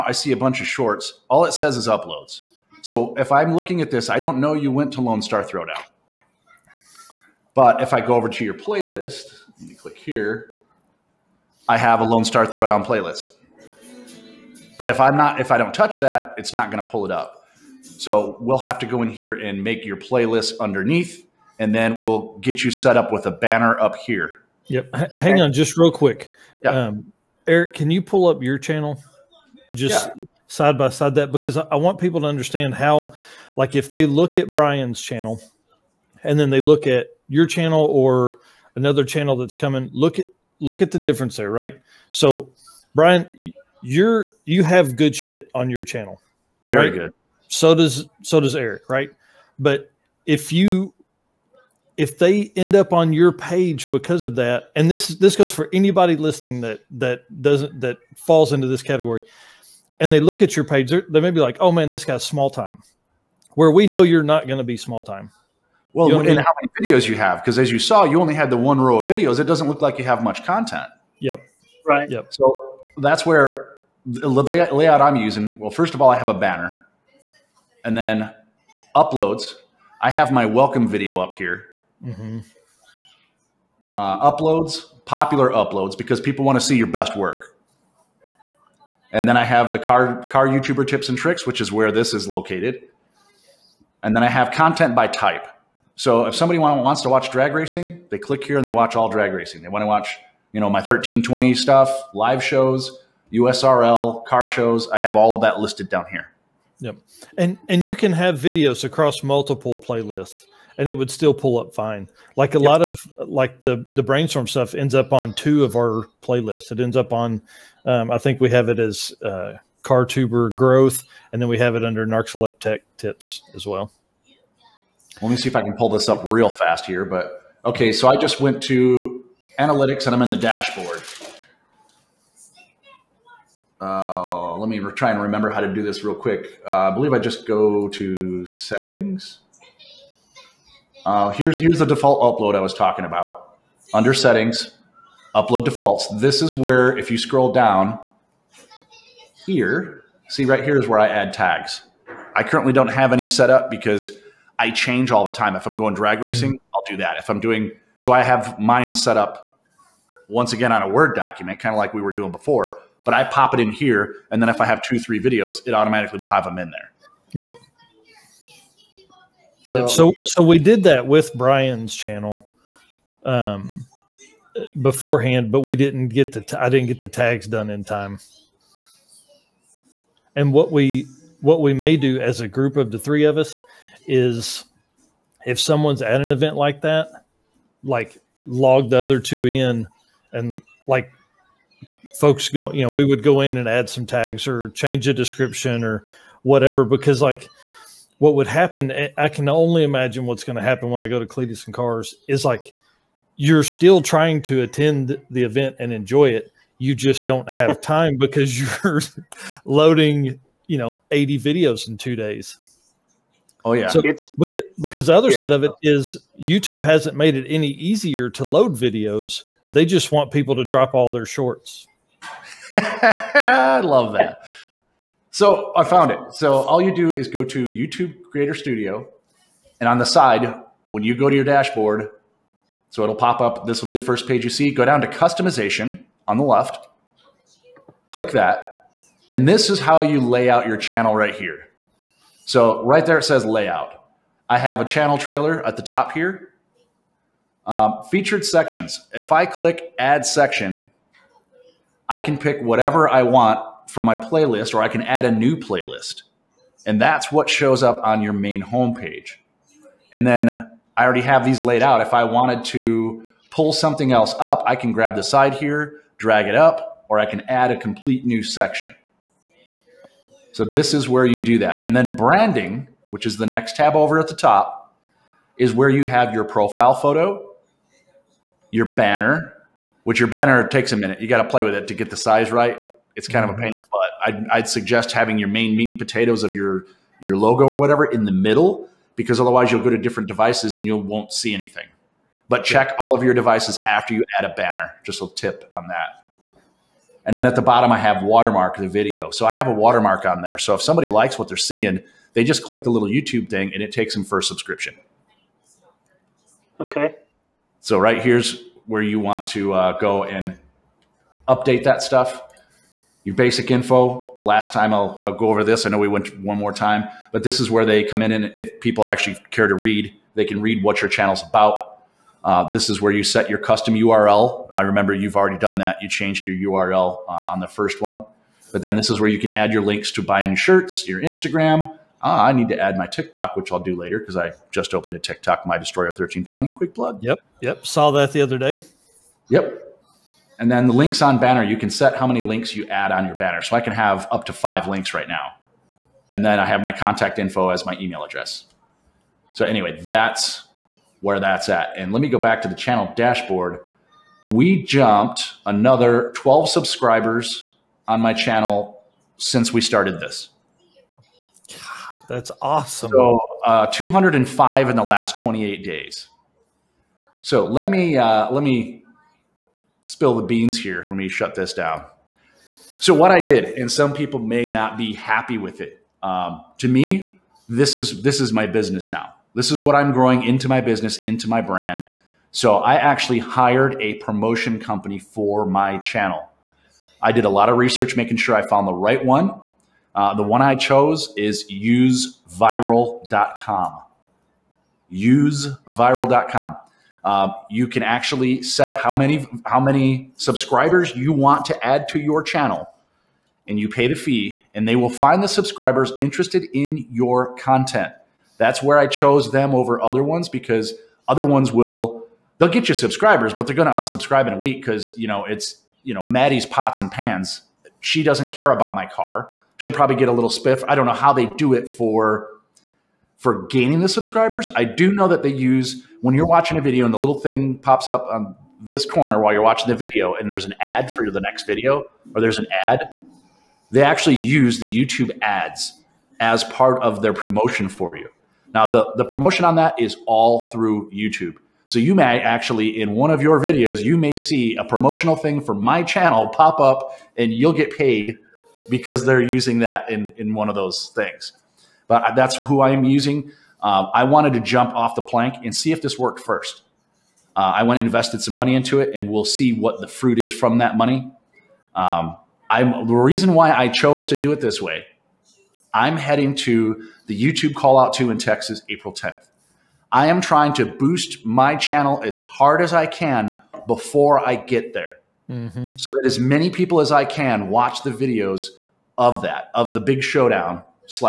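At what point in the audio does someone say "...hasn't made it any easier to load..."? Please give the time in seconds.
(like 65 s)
216 s.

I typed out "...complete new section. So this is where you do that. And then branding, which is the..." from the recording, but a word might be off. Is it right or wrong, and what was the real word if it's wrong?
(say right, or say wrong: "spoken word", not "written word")
right.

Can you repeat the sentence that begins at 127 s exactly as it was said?
But okay, so I just went to analytics and I'm in the dashboard.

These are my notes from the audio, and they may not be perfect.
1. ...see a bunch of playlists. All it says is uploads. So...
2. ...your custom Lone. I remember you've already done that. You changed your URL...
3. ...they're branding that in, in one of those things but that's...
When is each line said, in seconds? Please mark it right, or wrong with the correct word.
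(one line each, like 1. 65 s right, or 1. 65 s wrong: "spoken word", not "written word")
1. 0 s wrong: "shorts", not "playlists"
2. 323 s wrong: "URL", not "Lone"
3. 449 s wrong: "using", not "branding".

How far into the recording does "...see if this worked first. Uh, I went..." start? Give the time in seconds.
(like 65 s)
455 s.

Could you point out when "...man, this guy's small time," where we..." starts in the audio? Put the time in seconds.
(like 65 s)
61 s.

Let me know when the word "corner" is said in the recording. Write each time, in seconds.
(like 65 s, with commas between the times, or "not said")
429 s.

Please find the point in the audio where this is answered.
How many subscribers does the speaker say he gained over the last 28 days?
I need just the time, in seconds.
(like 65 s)
363 s.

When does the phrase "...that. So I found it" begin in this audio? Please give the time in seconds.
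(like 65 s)
224 s.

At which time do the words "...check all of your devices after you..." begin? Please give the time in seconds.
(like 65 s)
292 s.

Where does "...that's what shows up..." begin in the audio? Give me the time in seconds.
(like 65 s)
257 s.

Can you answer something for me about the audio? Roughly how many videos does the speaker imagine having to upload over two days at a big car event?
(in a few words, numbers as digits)
80.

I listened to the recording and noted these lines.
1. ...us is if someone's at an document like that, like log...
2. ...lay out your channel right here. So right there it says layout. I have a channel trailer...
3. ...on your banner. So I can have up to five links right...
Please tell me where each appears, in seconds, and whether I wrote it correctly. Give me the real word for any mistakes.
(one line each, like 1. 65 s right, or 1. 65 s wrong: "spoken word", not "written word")
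1. 183 s wrong: "event", not "document"
2. 240 s right
3. 343 s right.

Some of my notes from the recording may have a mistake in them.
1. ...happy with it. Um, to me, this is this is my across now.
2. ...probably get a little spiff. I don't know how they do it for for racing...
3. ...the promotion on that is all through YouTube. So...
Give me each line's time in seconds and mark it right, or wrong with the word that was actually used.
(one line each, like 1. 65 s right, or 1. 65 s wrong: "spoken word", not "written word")
1. 375 s wrong: "business", not "across"
2. 419 s wrong: "gaining", not "racing"
3. 439 s right.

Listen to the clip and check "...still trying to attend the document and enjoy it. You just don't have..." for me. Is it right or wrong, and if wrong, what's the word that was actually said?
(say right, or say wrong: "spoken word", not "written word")
wrong: "event", not "document".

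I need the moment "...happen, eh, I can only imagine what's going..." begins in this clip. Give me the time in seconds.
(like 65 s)
198 s.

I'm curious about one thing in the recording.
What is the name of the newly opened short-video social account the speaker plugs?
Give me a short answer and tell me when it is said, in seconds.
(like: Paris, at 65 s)
My Destroyer 1320, at 335 s.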